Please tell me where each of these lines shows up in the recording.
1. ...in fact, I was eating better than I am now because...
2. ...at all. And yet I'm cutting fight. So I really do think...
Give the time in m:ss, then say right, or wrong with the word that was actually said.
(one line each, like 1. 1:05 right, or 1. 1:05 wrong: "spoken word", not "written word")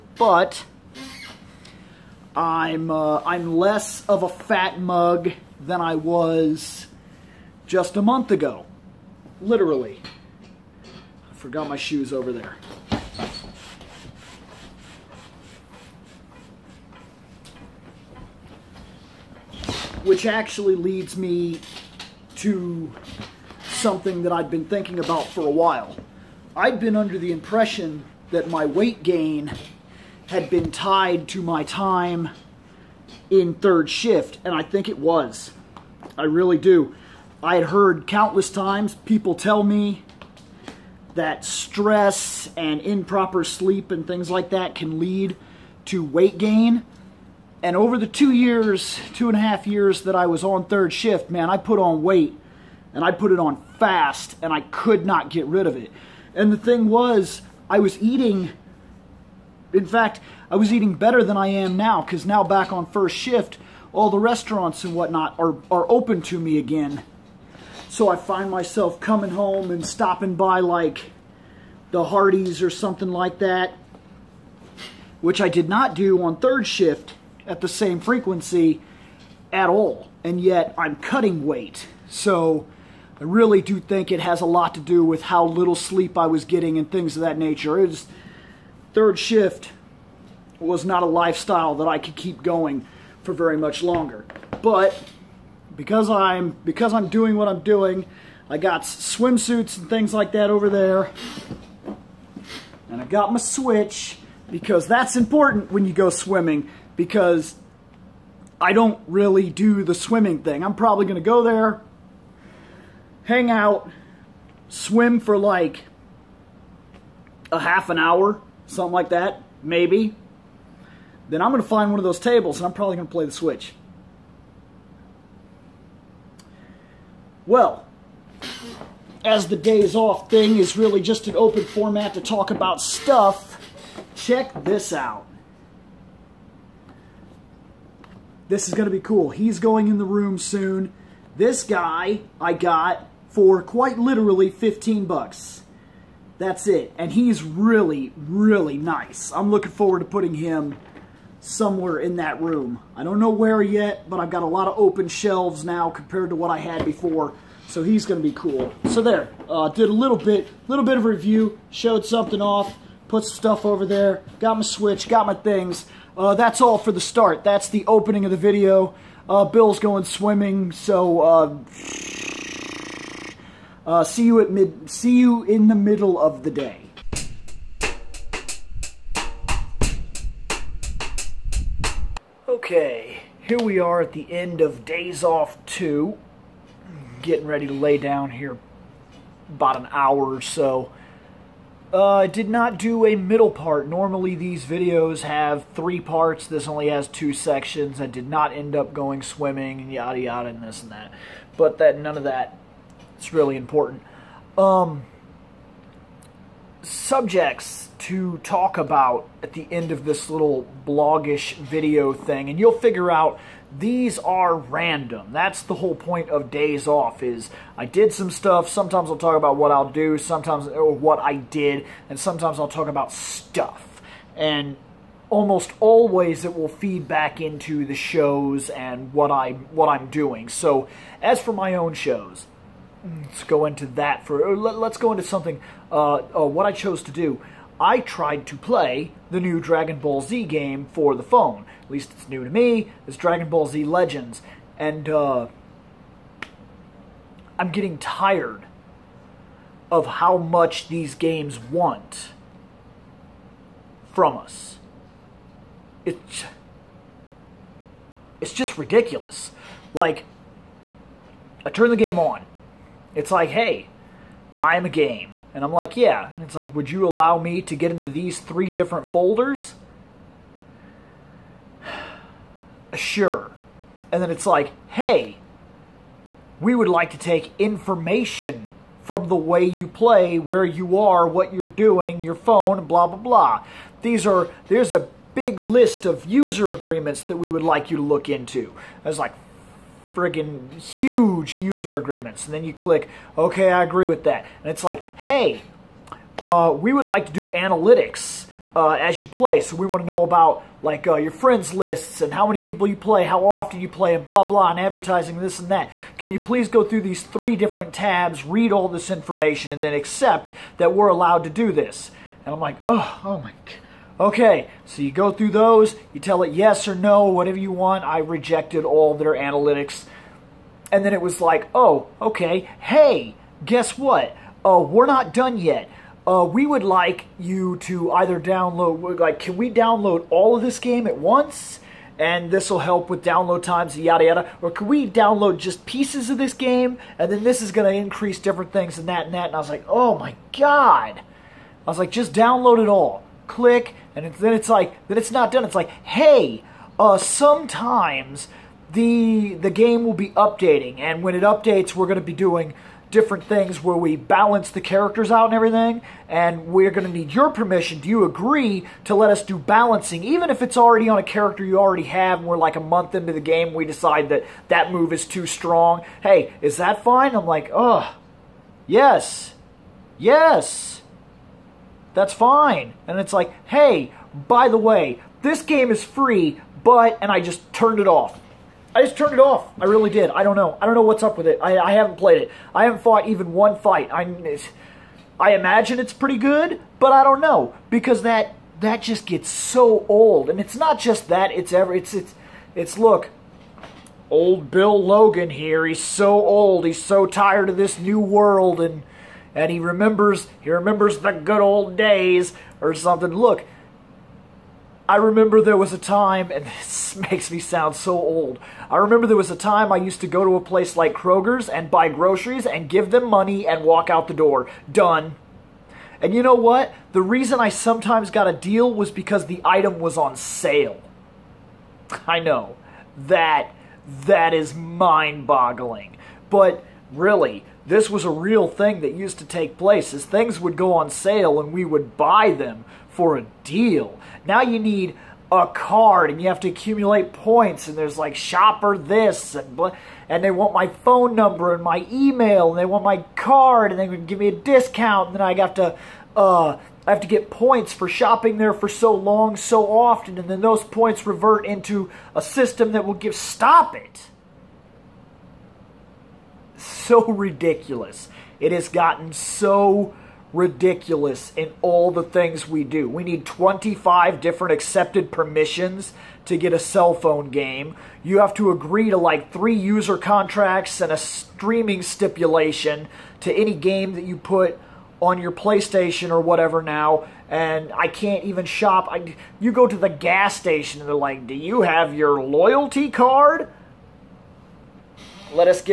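1. 0:59 right
2. 1:19 wrong: "weight", not "fight".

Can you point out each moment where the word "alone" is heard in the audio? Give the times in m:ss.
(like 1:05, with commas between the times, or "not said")
not said.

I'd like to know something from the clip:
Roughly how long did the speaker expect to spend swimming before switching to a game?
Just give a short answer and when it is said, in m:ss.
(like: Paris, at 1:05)
half an hour, at 1:57.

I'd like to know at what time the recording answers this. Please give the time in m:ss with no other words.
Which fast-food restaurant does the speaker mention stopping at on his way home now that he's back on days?
1:12.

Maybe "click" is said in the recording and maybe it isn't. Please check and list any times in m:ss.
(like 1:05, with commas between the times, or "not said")
4:52, 5:43.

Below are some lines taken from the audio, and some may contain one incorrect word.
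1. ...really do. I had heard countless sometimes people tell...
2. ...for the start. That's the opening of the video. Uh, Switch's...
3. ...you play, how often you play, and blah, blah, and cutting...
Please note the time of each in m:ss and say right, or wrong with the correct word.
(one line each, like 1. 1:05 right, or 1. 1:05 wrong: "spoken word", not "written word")
1. 0:36 wrong: "times", not "sometimes"
2. 2:46 wrong: "Bill", not "Switch"
3. 5:02 wrong: "advertising", not "cutting".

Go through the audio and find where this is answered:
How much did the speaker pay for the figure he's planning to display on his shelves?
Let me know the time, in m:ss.
2:24.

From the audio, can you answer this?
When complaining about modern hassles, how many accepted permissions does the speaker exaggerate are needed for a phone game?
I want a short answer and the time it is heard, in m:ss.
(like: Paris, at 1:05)
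25, at 7:43.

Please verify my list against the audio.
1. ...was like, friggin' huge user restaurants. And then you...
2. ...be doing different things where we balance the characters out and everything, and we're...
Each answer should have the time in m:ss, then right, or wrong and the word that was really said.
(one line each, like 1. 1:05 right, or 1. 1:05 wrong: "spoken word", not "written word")
1. 4:49 wrong: "agreements", not "restaurants"
2. 5:52 right.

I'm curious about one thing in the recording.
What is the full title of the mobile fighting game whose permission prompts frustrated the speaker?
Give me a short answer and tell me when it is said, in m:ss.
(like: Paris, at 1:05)
Dragon Ball Z Legends, at 4:03.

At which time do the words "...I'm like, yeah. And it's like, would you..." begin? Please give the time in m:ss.
4:25.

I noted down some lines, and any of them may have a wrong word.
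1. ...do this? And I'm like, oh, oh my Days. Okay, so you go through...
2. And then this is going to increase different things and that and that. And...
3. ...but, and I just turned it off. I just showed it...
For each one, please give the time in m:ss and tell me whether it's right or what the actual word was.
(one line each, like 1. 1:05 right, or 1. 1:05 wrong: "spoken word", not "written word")
1. 5:11 wrong: "God", not "Days"
2. 5:37 right
3. 6:16 wrong: "turned", not "showed".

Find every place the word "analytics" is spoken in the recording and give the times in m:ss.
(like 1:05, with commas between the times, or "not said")
4:57, 5:19.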